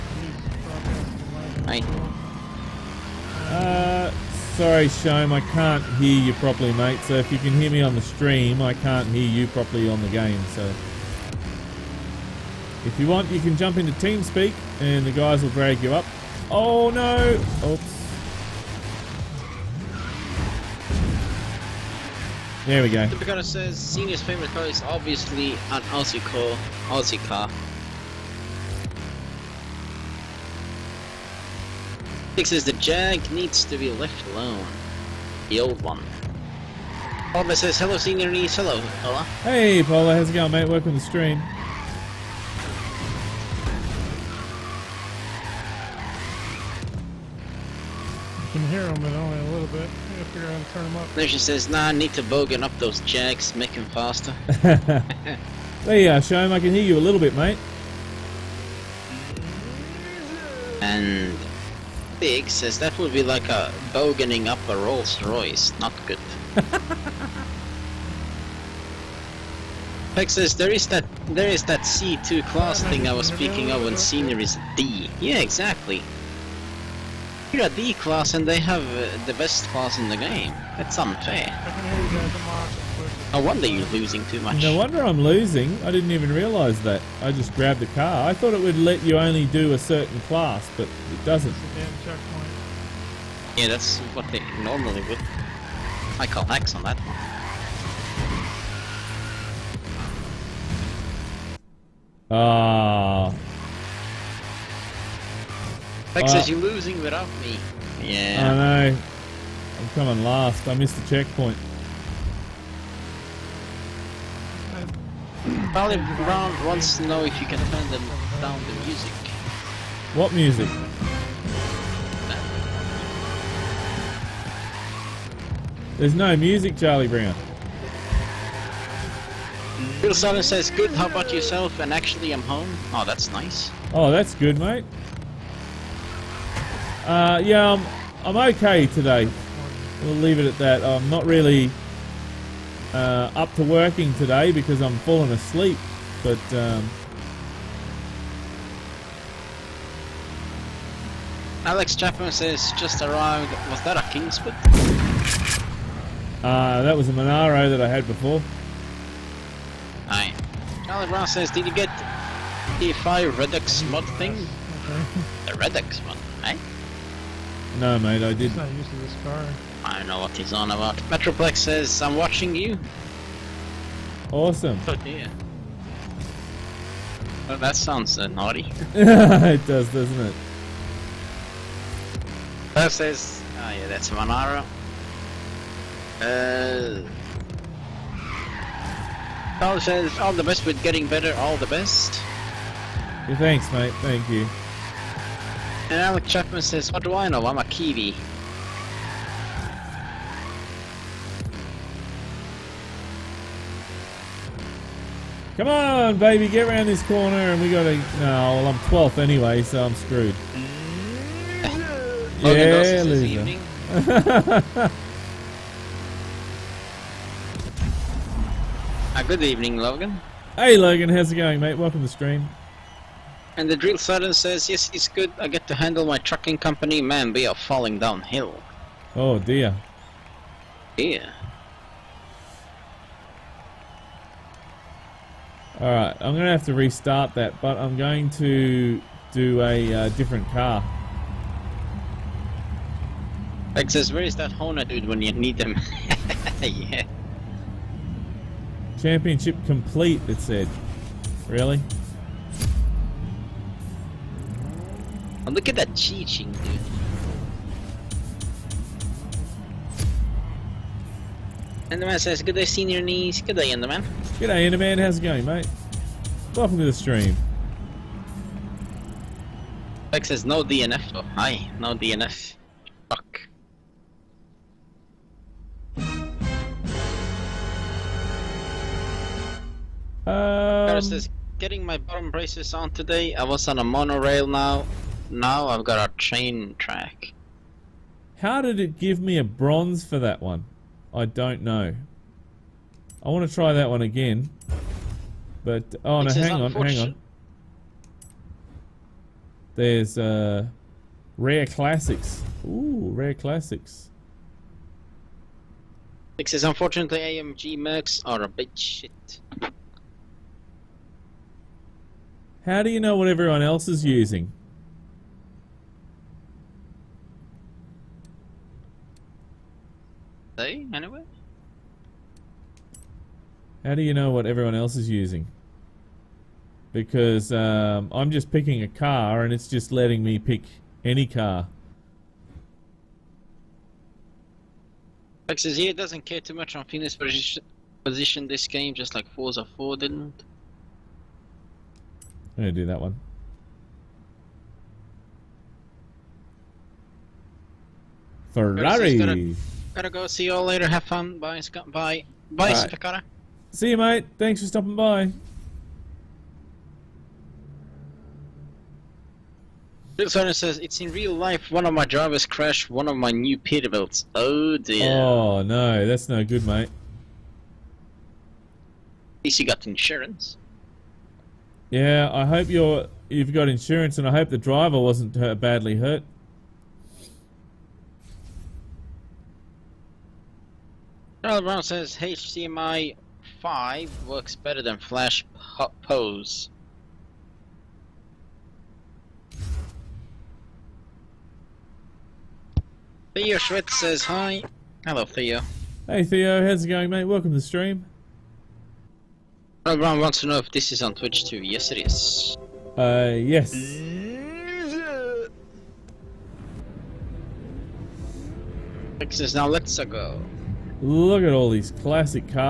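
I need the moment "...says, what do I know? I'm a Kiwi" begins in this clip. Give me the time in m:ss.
3:16.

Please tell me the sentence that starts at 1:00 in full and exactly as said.
And Big says that would be like a boganing up a Rolls Royce, not good.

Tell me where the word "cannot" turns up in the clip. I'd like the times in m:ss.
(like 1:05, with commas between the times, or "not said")
not said.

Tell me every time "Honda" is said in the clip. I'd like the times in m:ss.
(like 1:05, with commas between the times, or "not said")
4:04.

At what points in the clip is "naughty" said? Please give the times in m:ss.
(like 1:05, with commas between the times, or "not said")
2:58.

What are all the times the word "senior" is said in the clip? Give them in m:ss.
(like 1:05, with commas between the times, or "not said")
0:23, 0:37, 4:22.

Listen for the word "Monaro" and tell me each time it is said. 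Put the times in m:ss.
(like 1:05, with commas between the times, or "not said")
2:37, 3:04.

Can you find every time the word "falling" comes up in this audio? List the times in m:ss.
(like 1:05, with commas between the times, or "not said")
2:24, 3:47.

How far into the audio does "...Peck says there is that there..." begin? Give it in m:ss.
1:10.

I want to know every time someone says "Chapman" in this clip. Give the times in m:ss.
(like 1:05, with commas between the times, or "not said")
2:31, 3:16.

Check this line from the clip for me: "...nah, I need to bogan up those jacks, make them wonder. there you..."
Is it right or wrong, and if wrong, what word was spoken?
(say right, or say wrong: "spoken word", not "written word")
wrong: "faster", not "wonder".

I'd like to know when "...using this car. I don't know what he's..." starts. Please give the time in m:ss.
2:48.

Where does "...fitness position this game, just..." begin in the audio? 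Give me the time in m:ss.
5:36.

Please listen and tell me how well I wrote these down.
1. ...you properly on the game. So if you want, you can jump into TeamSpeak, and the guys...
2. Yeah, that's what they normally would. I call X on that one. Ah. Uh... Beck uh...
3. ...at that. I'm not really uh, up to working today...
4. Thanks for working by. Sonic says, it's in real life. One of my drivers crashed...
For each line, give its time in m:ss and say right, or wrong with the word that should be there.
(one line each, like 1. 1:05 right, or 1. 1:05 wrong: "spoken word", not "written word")
1. 0:09 right
2. 1:33 right
3. 2:20 right
4. 5:54 wrong: "stopping", not "working".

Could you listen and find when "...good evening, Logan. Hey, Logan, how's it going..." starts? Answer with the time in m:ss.
3:39.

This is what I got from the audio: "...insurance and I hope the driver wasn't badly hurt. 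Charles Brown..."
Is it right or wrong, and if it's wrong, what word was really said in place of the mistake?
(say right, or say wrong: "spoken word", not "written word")
right.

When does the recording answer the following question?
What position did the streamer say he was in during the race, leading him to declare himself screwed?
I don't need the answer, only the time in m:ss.
3:28.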